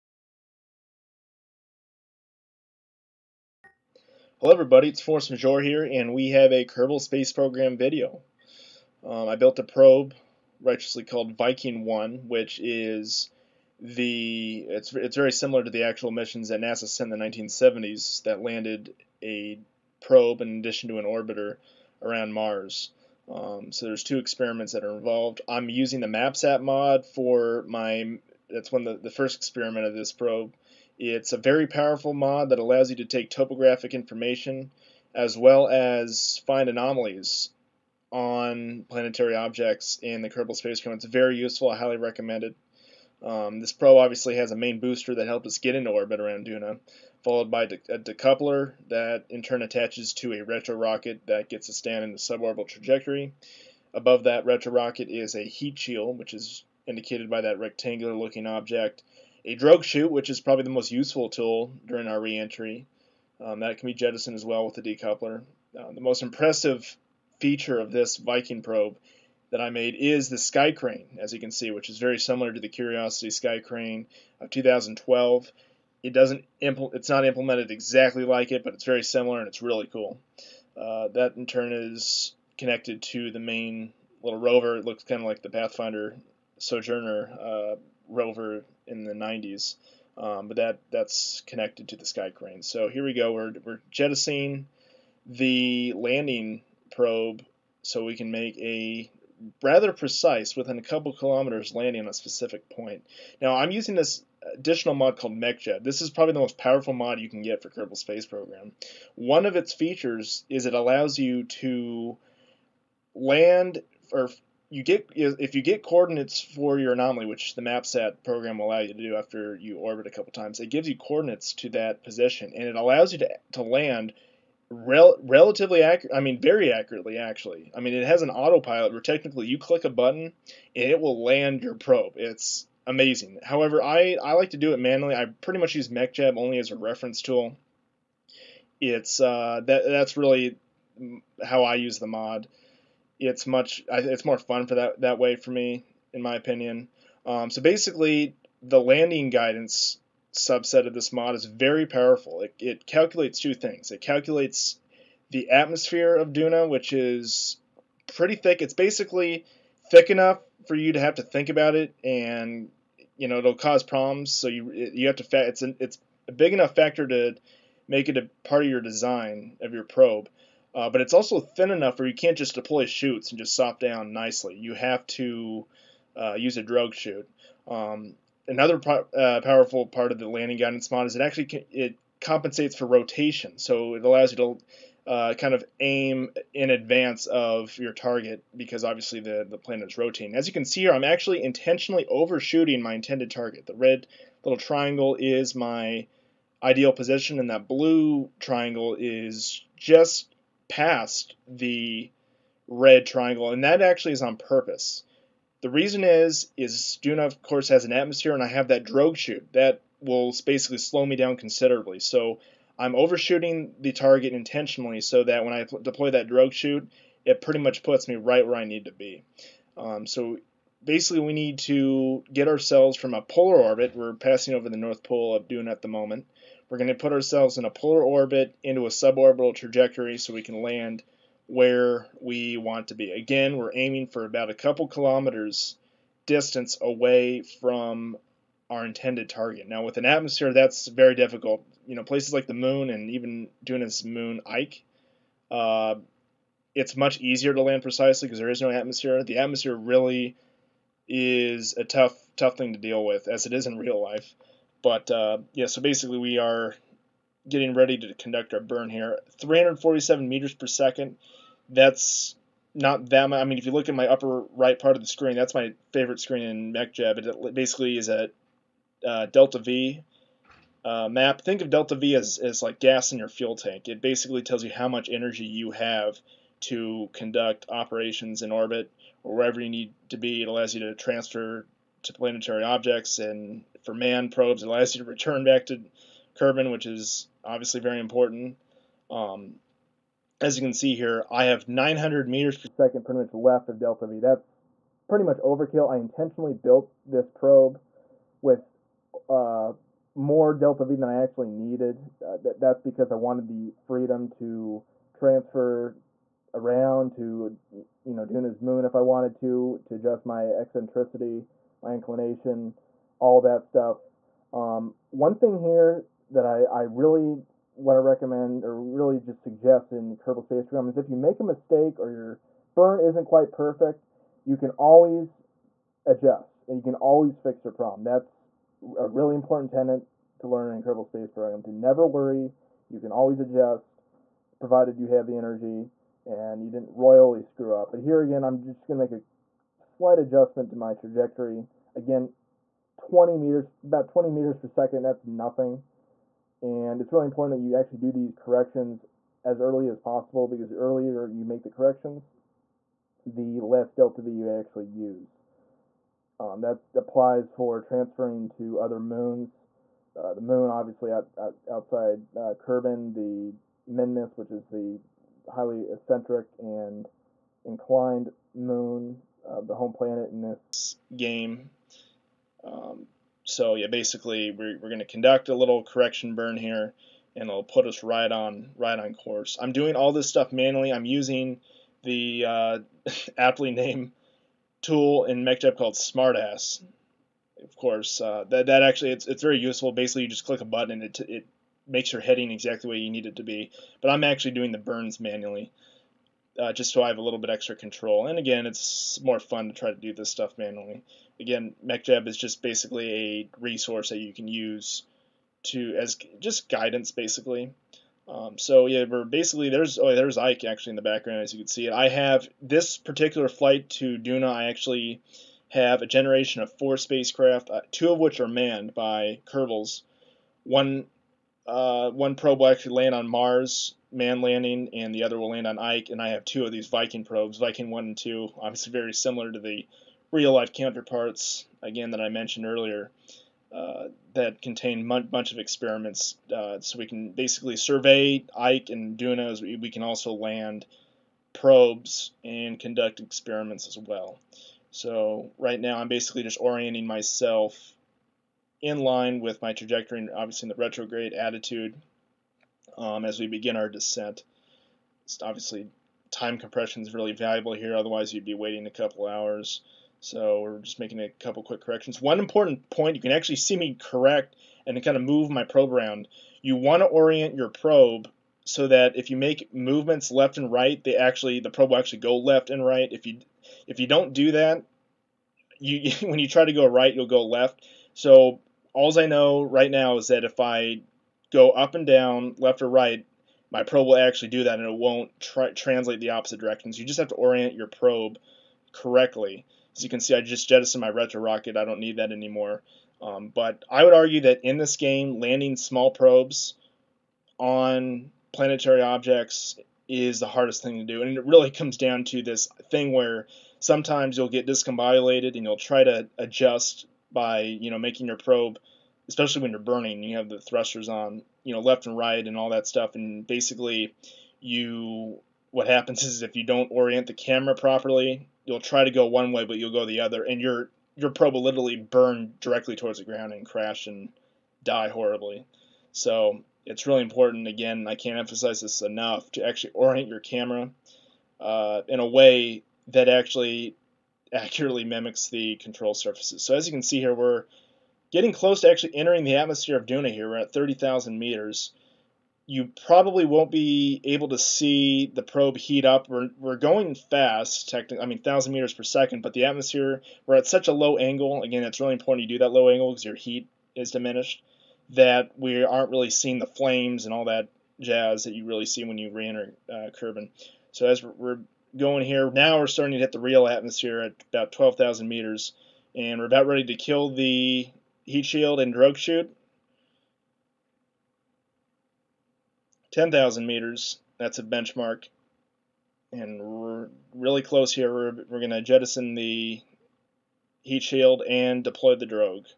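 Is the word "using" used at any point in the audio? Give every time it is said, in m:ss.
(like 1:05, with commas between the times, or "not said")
0:25, 1:43, 6:21.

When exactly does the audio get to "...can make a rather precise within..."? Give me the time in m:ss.
1:38.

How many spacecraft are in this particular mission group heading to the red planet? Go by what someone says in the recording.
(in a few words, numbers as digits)
4.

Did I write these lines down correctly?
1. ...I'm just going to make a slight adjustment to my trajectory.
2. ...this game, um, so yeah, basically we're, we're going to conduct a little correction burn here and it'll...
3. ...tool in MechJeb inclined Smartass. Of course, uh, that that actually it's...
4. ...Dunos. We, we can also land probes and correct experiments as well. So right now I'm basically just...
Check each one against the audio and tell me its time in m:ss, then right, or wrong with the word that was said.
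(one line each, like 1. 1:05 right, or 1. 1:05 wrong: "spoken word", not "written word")
1. 5:38 right
2. 6:10 right
3. 6:24 wrong: "called", not "inclined"
4. 7:19 wrong: "conduct", not "correct".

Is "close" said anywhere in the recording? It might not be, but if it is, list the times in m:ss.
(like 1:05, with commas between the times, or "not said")
8:58, 9:37.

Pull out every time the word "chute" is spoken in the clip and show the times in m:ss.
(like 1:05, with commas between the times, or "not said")
0:59, 2:52, 2:56, 3:29, 3:36, 9:29.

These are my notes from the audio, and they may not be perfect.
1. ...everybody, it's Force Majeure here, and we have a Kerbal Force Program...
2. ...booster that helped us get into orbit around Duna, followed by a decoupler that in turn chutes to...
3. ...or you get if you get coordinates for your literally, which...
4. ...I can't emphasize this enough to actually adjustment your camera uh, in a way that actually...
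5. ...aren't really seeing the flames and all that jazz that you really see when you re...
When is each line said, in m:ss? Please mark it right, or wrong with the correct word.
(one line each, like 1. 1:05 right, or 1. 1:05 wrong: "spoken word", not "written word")
1. 0:04 wrong: "Space", not "Force"
2. 0:44 wrong: "attaches", not "chutes"
3. 1:54 wrong: "anomaly", not "literally"
4. 8:48 wrong: "orient", not "adjustment"
5. 9:15 right.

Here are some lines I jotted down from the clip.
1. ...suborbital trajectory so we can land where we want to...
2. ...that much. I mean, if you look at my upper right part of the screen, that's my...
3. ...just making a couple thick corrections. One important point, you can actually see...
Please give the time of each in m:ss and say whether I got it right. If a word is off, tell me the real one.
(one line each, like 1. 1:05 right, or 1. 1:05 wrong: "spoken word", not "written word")
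1. 3:48 right
2. 4:23 right
3. 7:40 wrong: "quick", not "thick".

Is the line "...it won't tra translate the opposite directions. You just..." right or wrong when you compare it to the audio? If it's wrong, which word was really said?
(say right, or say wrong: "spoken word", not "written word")
right.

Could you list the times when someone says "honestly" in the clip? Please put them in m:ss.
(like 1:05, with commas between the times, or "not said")
not said.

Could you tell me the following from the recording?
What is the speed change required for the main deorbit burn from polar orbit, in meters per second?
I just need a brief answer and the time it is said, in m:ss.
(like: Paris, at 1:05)
347, at 4:19.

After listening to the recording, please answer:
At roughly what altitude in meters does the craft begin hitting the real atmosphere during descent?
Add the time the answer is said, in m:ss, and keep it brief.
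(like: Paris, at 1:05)
12,000, at 9:24.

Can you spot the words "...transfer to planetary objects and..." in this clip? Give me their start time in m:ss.
4:40.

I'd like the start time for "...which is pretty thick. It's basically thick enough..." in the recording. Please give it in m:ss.
2:36.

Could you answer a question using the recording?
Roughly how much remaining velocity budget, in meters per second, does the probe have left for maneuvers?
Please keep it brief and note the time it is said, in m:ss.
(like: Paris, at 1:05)
900, at 4:51.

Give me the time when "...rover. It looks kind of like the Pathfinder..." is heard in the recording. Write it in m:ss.
1:24.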